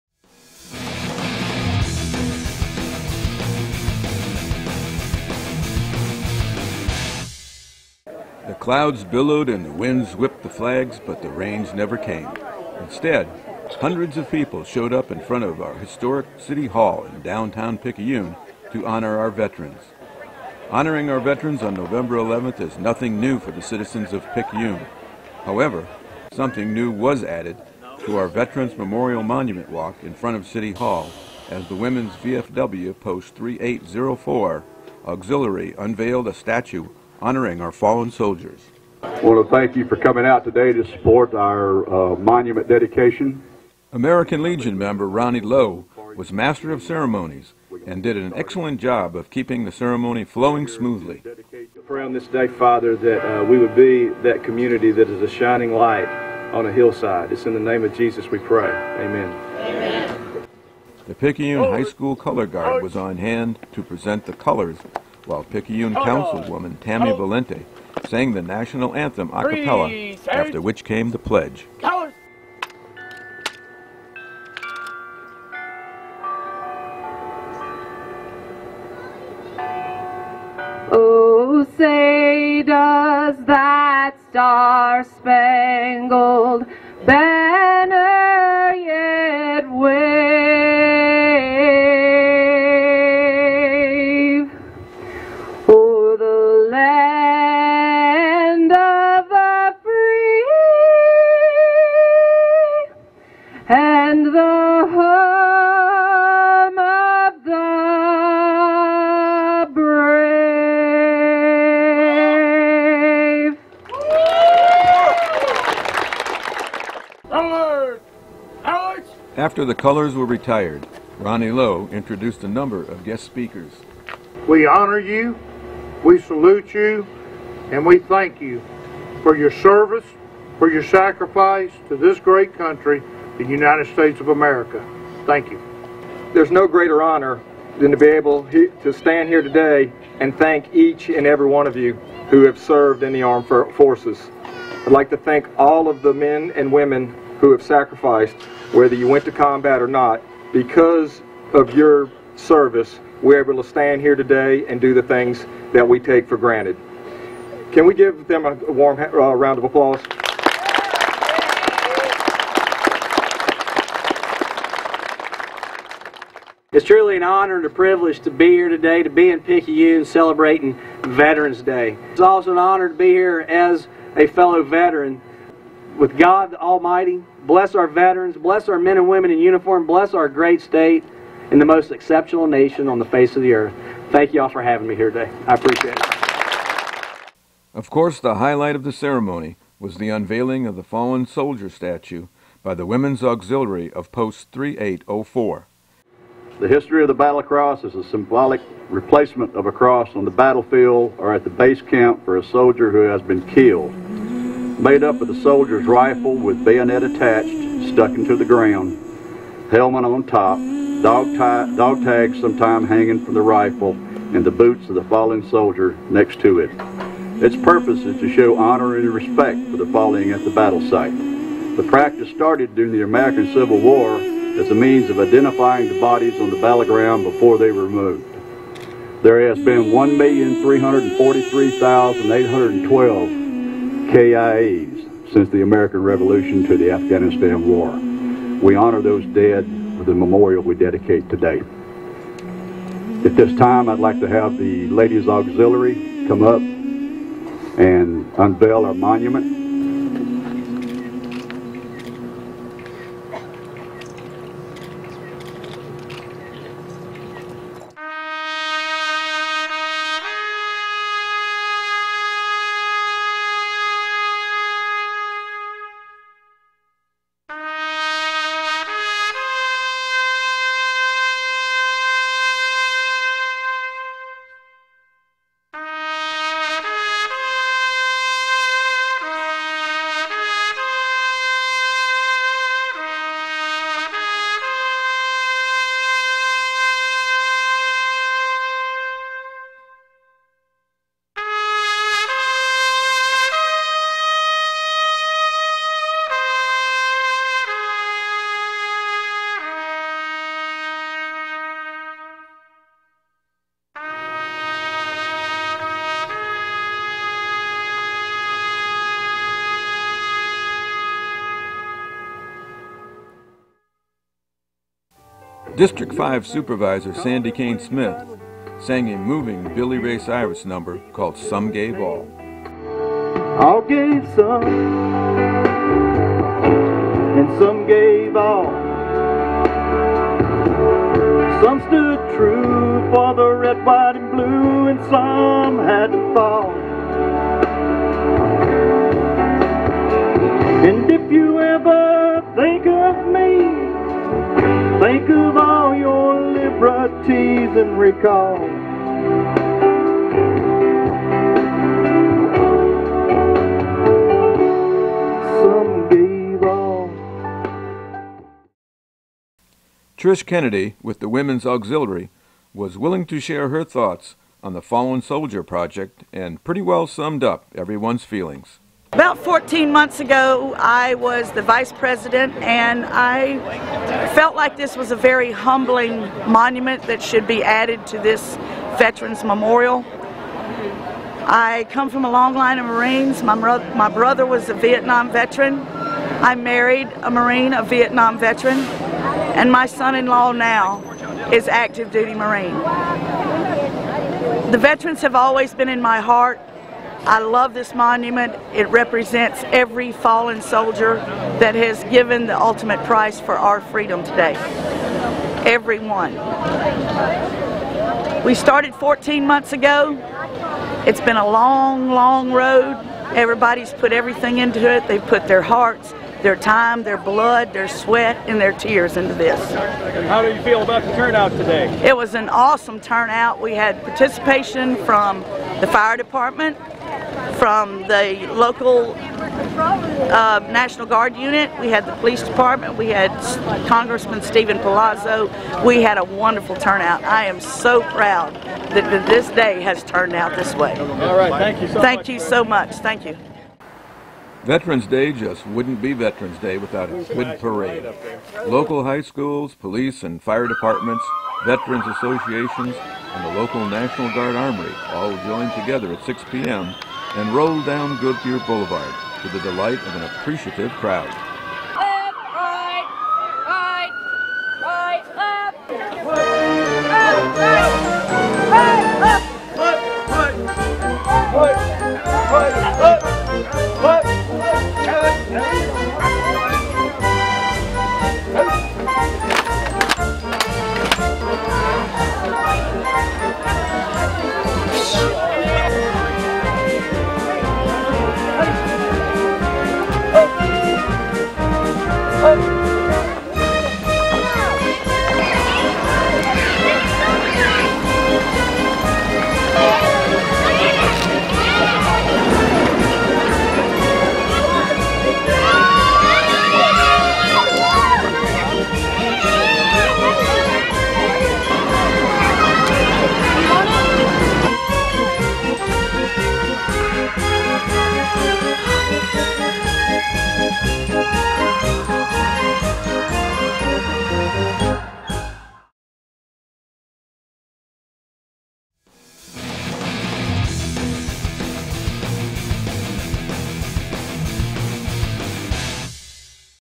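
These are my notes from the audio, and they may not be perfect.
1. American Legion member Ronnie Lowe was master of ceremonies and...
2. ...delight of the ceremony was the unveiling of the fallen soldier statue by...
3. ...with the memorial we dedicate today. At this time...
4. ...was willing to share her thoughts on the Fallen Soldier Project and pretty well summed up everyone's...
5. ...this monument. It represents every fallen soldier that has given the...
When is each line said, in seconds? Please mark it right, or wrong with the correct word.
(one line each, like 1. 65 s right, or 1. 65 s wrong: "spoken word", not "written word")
1. 43 s right
2. 188 s wrong: "highlight", not "delight"
3. 239 s right
4. 362 s right
5. 397 s right.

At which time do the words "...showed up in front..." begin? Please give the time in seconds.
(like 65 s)
14 s.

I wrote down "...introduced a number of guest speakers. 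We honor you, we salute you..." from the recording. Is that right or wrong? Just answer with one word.
right.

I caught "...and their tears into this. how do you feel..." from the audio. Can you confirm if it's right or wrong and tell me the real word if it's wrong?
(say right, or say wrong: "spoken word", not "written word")
right.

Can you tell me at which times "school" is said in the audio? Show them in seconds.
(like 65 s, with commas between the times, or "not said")
61 s, 449 s.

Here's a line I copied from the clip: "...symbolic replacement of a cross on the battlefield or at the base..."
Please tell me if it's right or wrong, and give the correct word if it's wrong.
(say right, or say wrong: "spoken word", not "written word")
right.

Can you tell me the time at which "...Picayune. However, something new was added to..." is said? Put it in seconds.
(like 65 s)
24 s.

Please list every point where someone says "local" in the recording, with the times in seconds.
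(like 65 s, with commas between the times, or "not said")
428 s, 448 s, 453 s.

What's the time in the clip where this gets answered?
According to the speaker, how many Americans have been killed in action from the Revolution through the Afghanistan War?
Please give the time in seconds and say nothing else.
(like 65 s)
229 s.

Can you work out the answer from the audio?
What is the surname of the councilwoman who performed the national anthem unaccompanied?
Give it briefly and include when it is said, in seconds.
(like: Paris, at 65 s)
Valente, at 67 s.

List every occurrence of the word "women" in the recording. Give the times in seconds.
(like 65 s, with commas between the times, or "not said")
31 s, 146 s, 179 s, 192 s, 361 s.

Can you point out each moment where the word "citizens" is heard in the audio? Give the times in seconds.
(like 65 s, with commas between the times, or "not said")
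23 s.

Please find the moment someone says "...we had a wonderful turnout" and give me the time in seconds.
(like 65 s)
435 s.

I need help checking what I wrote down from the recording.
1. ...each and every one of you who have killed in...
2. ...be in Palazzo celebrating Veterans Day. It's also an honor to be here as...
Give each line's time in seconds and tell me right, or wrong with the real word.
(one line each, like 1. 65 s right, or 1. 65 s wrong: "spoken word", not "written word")
1. 140 s wrong: "served", not "killed"
2. 169 s wrong: "Picayune", not "Palazzo".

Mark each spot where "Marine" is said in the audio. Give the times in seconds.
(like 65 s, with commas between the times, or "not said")
382 s, 387 s, 392 s.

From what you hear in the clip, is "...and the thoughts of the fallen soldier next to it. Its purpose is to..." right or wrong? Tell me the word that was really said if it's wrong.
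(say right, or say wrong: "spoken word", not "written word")
wrong: "boots", not "thoughts".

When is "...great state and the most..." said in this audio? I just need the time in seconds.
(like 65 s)
180 s.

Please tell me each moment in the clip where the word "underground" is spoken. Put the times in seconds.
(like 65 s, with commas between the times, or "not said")
not said.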